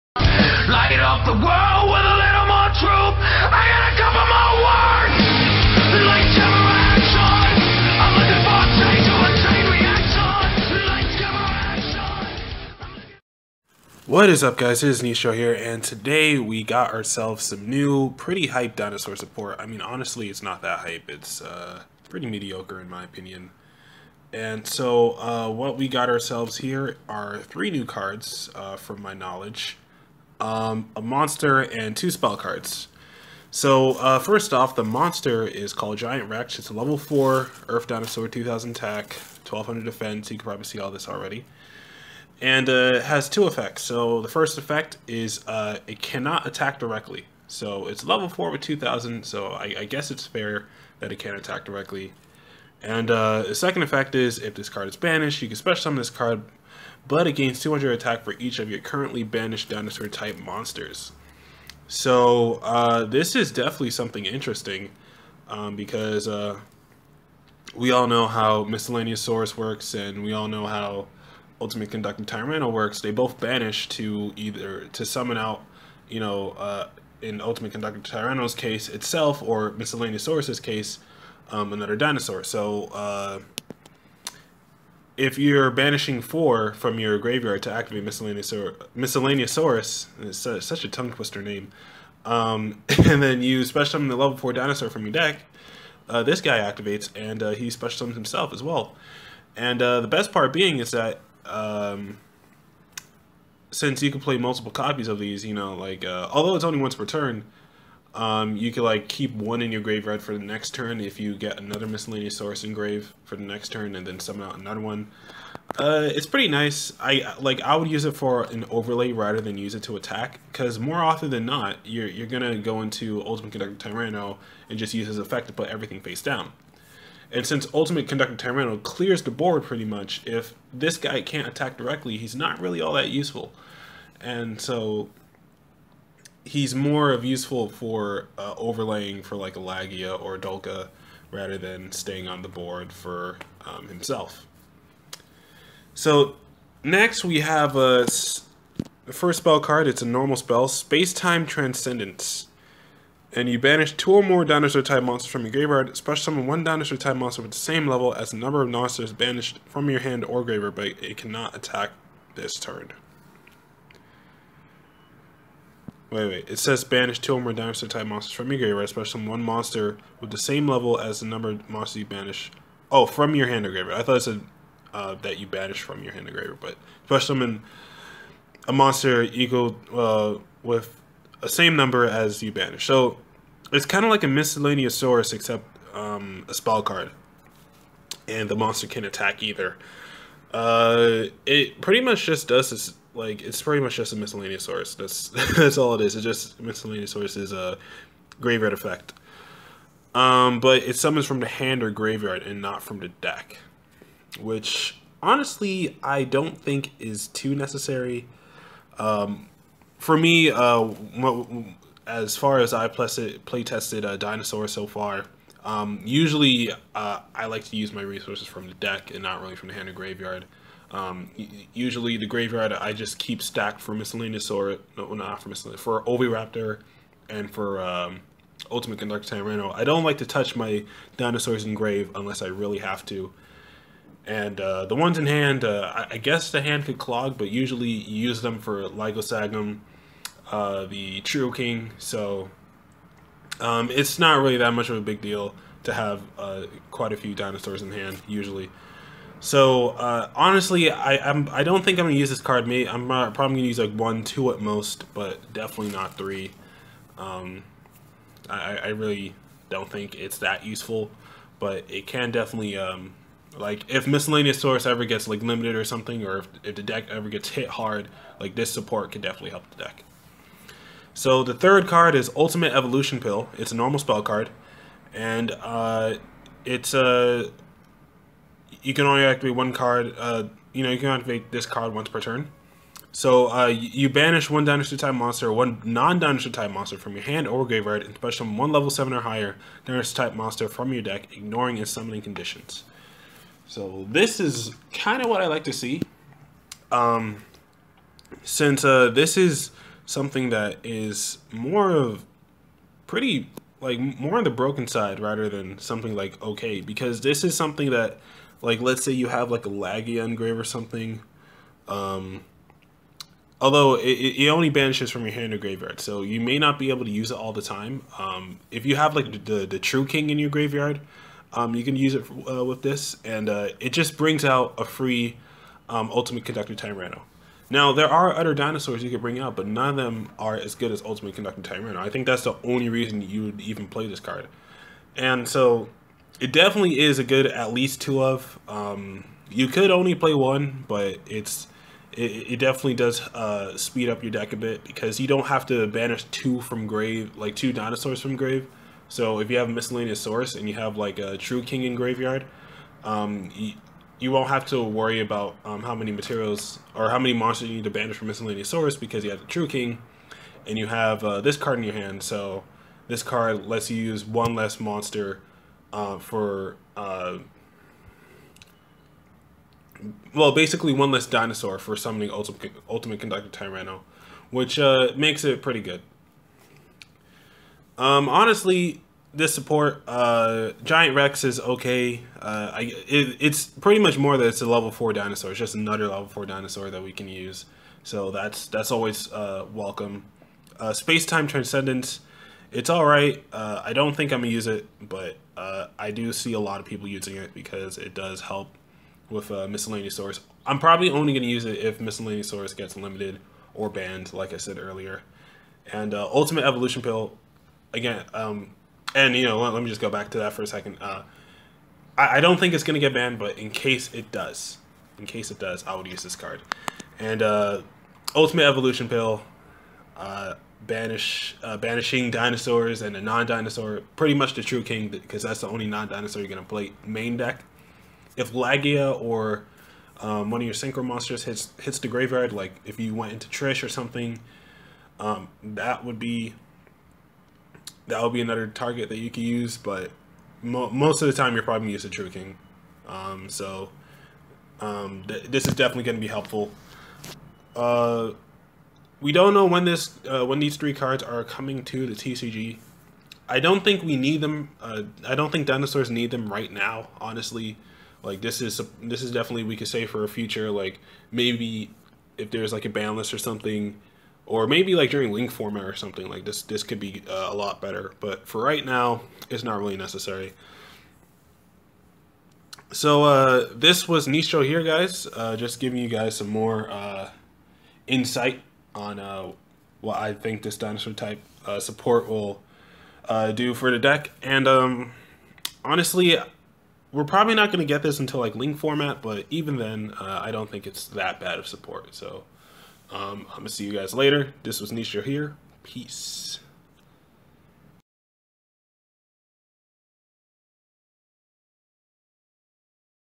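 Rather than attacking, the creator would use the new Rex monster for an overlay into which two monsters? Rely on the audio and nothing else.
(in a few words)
Laggia or Dolkka.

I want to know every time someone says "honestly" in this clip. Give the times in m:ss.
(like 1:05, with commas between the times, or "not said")
0:19, 3:25, 4:10, 6:18, 7:37, 8:05.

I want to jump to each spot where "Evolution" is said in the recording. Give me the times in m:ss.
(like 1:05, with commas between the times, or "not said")
4:32, 6:46, 6:58.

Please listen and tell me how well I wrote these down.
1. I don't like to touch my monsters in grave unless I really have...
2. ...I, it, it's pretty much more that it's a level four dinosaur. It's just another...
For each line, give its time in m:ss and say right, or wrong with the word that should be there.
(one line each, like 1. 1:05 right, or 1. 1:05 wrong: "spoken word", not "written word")
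1. 3:49 wrong: "dinosaurs", not "monsters"
2. 6:22 right.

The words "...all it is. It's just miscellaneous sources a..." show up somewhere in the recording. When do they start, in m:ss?
3:15.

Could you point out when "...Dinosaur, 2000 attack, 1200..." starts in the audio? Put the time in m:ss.
0:37.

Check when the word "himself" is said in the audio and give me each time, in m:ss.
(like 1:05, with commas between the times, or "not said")
1:38, 2:23.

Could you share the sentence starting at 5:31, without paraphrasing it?
I think that's the only reason you would even play this card.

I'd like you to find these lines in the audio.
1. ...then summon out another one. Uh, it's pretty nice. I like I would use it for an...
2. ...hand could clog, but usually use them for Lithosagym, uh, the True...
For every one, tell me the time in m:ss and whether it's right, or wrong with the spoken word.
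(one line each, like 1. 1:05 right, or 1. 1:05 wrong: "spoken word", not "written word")
1. 1:54 right
2. 3:56 right.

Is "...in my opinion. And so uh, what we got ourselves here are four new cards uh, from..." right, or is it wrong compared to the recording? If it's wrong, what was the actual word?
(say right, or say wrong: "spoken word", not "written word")
wrong: "three", not "four".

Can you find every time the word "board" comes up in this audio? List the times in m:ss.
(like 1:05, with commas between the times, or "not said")
2:09, 2:22.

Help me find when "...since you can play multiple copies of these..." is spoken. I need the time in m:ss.
1:43.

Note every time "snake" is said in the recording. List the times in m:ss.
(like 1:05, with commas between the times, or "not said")
not said.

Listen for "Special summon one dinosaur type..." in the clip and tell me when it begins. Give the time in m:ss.
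2:35.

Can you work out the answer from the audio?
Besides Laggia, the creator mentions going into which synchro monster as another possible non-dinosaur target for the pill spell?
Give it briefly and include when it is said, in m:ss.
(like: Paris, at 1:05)
Trish, at 7:13.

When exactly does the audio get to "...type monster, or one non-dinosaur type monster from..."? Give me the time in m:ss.
4:44.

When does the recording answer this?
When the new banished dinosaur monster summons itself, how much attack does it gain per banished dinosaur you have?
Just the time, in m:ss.
0:57.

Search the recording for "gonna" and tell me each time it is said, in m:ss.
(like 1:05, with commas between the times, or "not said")
2:02, 6:34, 6:41, 6:52, 7:06, 7:21, 7:26.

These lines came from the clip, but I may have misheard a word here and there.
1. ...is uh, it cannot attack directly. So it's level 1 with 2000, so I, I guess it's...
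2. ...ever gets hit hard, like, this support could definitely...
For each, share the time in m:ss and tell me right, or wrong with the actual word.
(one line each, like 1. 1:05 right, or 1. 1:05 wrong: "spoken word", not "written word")
1. 0:45 wrong: "4", not "1"
2. 4:27 right.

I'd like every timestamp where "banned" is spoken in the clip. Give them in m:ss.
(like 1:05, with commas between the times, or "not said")
6:43, 6:53.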